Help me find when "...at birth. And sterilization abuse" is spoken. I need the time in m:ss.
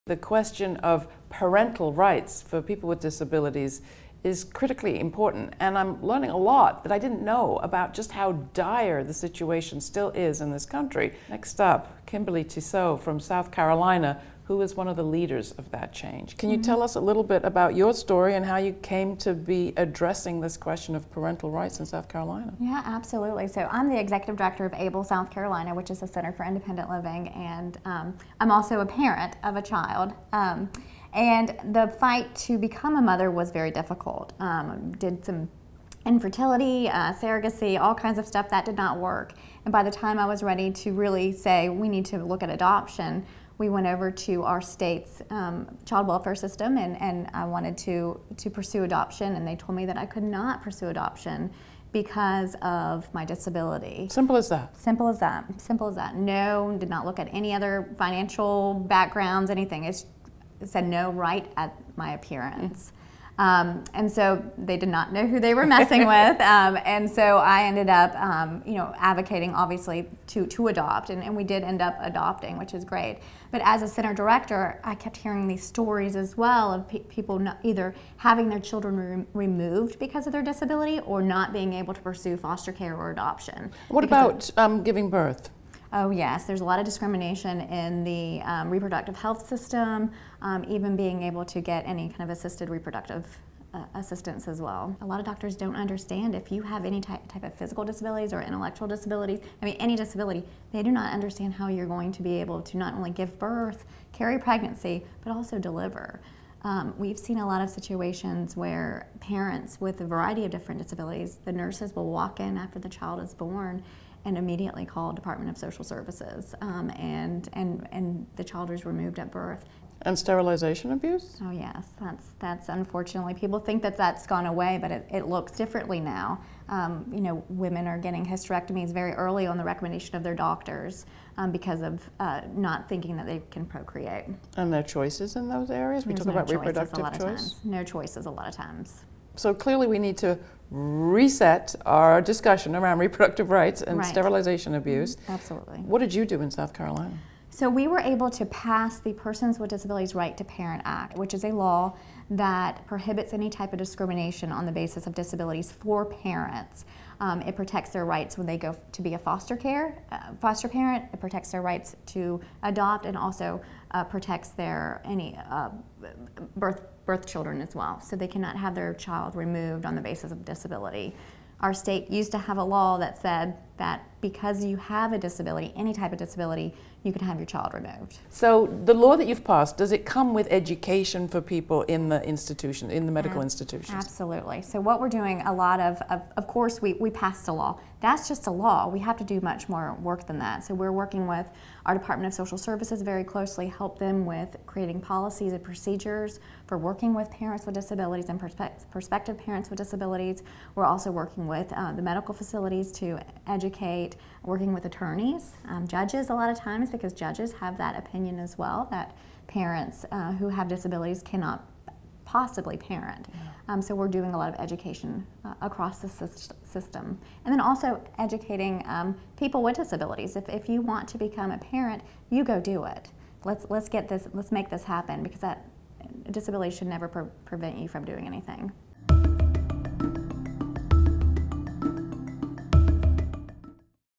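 1:59.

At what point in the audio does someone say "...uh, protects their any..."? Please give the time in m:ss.
2:43.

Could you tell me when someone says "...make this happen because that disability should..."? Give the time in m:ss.
3:44.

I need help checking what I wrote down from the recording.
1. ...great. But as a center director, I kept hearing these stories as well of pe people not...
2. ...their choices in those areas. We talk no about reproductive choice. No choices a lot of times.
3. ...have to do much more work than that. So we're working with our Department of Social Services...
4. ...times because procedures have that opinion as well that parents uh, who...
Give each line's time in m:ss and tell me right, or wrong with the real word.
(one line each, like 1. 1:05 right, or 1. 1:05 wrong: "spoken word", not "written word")
1. 1:12 right
2. 2:14 right
3. 3:08 right
4. 3:26 wrong: "judges", not "procedures".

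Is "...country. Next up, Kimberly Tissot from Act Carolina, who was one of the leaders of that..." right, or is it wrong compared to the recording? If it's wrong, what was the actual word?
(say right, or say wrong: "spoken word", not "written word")
wrong: "South", not "Act".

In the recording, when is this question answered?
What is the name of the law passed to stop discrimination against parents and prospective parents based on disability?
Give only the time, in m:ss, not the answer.
2:29.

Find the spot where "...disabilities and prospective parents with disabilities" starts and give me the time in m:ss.
3:17.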